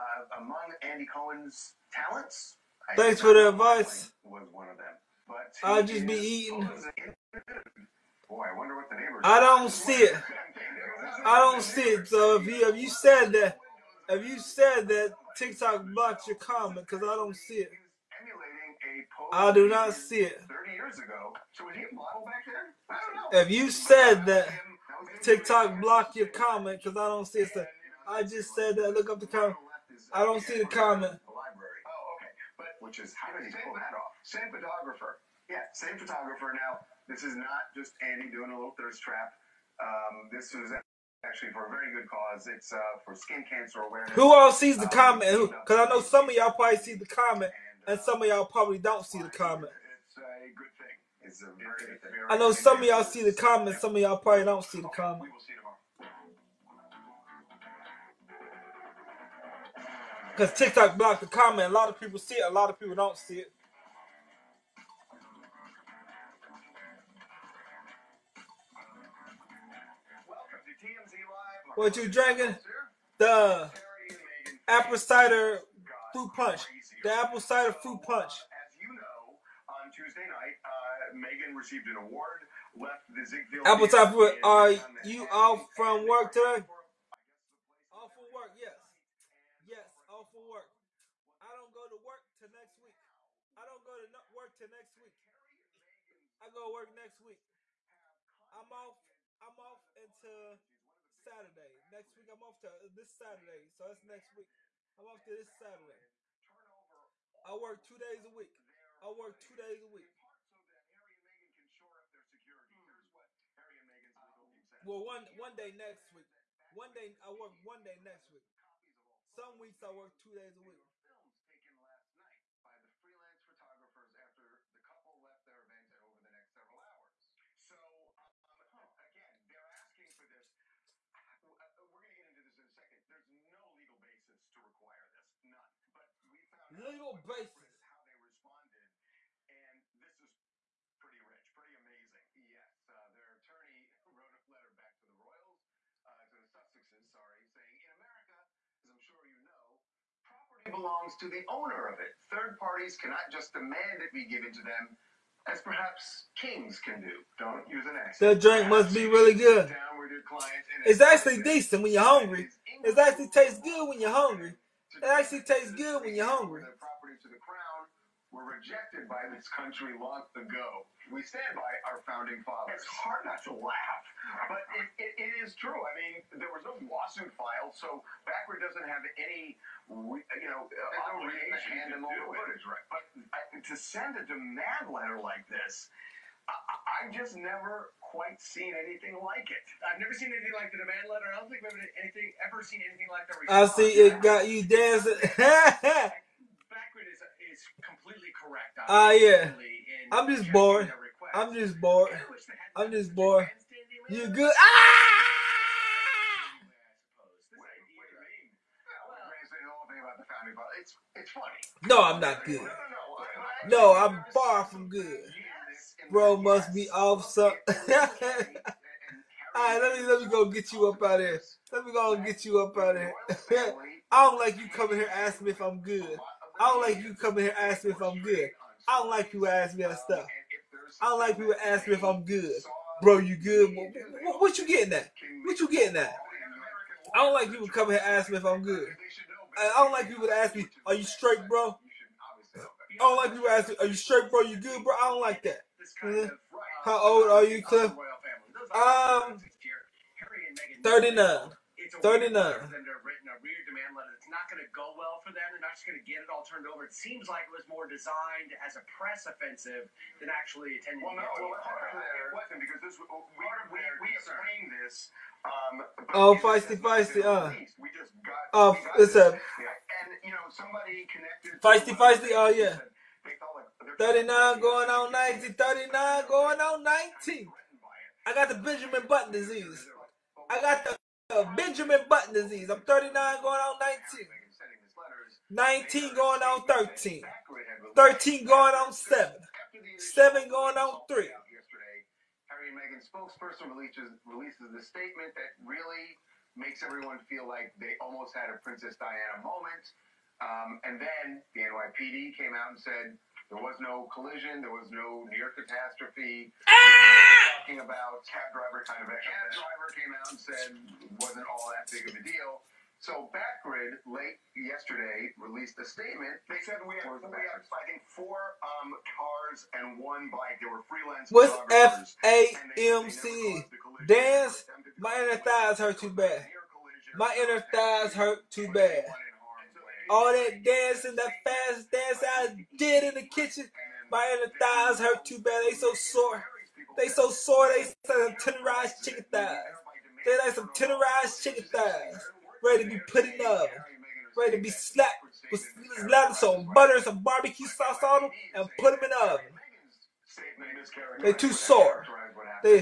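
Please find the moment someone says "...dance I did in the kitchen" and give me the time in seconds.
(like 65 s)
331 s.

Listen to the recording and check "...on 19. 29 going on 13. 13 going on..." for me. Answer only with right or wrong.
wrong.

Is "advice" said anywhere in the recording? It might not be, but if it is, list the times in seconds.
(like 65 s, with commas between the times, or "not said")
3 s.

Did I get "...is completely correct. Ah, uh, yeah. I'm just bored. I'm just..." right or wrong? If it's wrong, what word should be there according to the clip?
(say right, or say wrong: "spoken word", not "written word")
right.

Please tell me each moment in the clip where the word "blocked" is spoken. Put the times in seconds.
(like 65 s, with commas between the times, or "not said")
15 s, 25 s, 60 s.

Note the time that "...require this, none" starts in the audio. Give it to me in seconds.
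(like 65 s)
134 s.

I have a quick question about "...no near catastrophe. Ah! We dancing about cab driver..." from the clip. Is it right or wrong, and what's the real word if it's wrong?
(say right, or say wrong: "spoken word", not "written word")
wrong: "talking", not "dancing".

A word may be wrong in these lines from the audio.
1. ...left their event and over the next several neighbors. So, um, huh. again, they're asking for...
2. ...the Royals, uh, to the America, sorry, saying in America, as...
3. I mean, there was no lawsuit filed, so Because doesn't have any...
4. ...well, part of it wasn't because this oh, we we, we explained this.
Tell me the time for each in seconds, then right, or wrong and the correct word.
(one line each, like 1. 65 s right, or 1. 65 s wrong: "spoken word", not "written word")
1. 125 s wrong: "hours", not "neighbors"
2. 145 s wrong: "Sussexes", not "America"
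3. 175 s wrong: "Backgrid", not "Because"
4. 261 s right.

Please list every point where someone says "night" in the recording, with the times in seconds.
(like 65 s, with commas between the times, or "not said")
80 s, 122 s.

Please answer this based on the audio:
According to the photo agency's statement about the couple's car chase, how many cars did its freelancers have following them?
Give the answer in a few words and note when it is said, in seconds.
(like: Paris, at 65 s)
4, at 318 s.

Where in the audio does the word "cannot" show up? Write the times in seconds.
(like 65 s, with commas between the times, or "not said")
152 s.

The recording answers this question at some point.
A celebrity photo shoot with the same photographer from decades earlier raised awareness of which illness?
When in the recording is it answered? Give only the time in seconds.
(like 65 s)
43 s.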